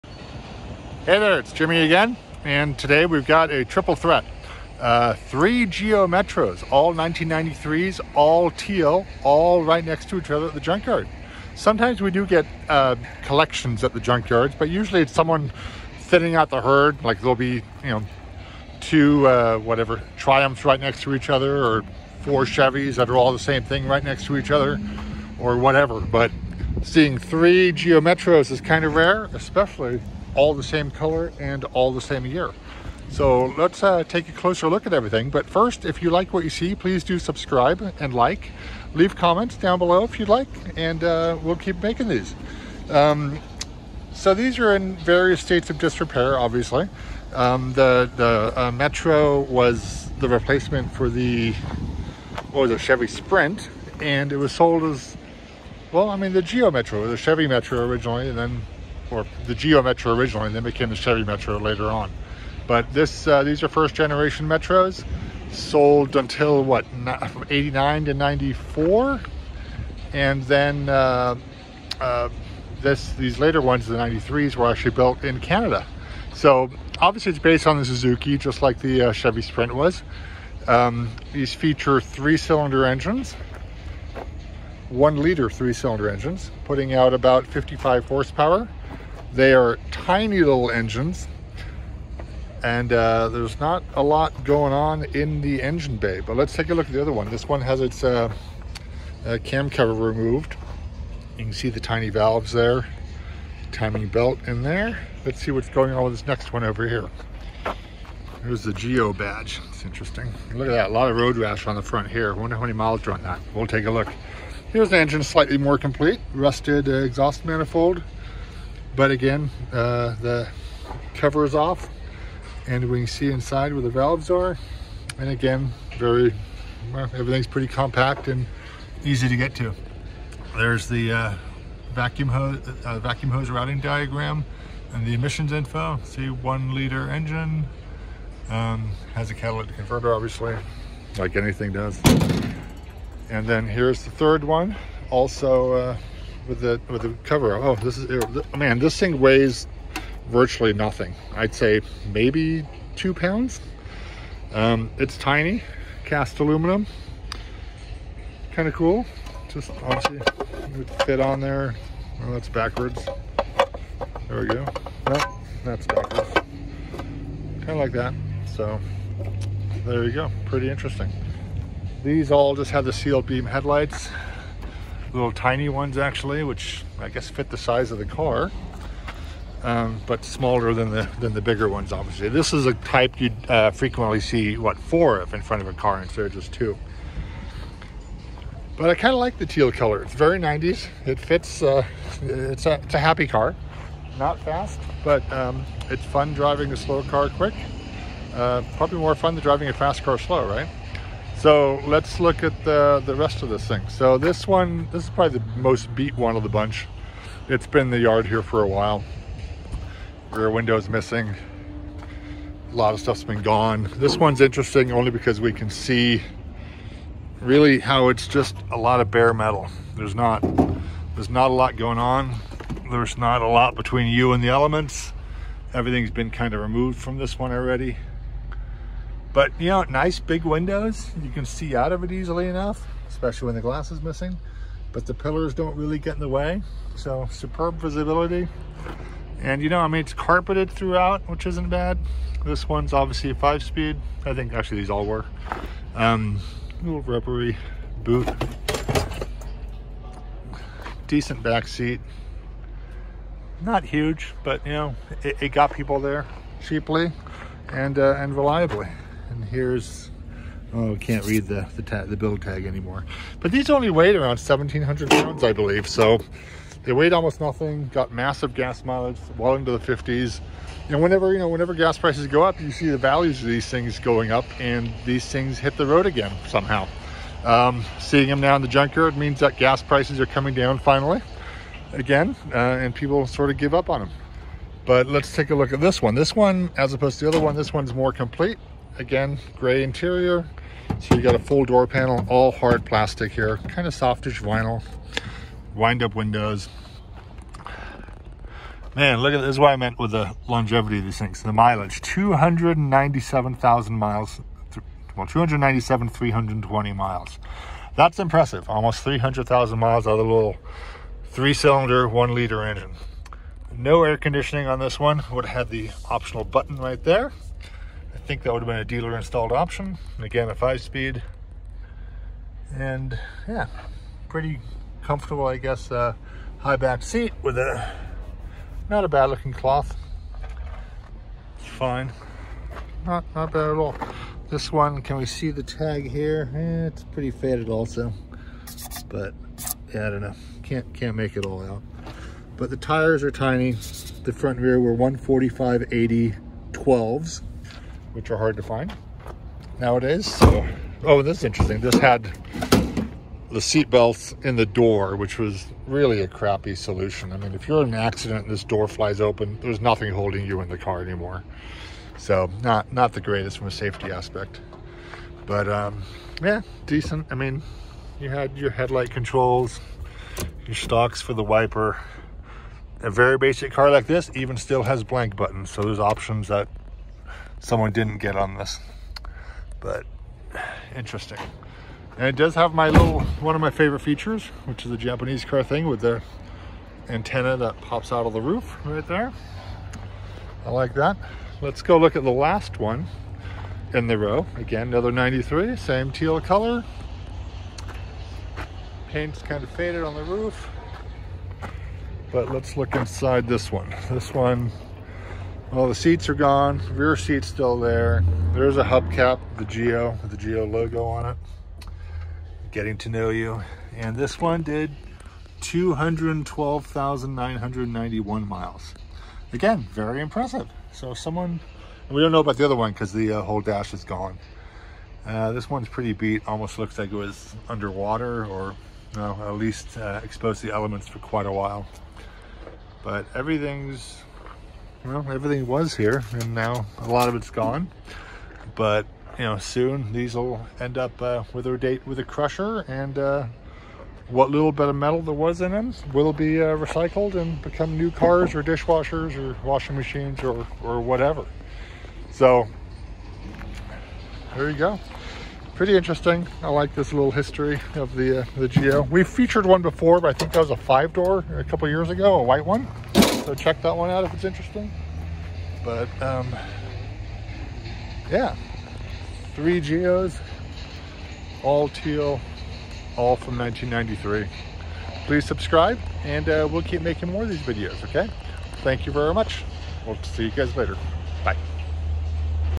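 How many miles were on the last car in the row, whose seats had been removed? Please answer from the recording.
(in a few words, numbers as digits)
212,991 miles.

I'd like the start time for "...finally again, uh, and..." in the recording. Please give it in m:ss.
4:40.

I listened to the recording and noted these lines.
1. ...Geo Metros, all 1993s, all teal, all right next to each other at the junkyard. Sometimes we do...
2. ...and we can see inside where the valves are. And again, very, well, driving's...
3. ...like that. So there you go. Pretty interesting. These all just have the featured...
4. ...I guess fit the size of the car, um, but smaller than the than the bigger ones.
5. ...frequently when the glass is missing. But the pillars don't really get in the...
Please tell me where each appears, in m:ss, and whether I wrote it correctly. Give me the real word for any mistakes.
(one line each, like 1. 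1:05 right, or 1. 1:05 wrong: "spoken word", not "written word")
1. 0:05 right
2. 2:02 wrong: "everything", not "driving"
3. 2:47 wrong: "sealed", not "featured"
4. 2:56 right
5. 3:53 wrong: "especially", not "frequently".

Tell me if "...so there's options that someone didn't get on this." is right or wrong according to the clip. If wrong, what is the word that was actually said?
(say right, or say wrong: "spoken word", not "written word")
right.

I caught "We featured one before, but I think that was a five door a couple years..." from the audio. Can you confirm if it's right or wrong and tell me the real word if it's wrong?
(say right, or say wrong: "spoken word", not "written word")
right.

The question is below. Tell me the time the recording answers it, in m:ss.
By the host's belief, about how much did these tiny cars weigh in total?
4:24.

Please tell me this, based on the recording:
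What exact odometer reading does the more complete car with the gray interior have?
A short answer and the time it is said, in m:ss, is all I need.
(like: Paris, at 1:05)
297,320 miles, at 5:05.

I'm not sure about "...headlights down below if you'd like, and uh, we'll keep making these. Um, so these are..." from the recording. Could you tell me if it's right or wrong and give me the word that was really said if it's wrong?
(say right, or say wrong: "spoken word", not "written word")
wrong: "comments", not "headlights".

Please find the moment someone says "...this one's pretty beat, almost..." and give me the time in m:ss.
7:05.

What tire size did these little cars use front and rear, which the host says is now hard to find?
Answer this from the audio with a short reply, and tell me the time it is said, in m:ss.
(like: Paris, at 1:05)
145/80/12, at 5:44.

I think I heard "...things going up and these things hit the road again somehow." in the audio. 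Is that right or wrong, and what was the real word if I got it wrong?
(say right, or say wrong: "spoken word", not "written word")
right.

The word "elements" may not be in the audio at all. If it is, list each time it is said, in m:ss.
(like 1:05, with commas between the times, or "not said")
3:44, 7:10.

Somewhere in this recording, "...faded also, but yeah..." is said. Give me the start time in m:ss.
5:37.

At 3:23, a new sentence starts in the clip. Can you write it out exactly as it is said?
So this one, this is probably the most beat one of the bunch.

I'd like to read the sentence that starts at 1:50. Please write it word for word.
Look at that, a lot of road rash on the front here.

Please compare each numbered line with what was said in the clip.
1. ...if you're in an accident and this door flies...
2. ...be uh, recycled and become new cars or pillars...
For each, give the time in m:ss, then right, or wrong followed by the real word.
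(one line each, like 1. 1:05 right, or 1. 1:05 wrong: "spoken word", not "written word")
1. 5:57 right
2. 7:26 wrong: "dishwashers", not "pillars".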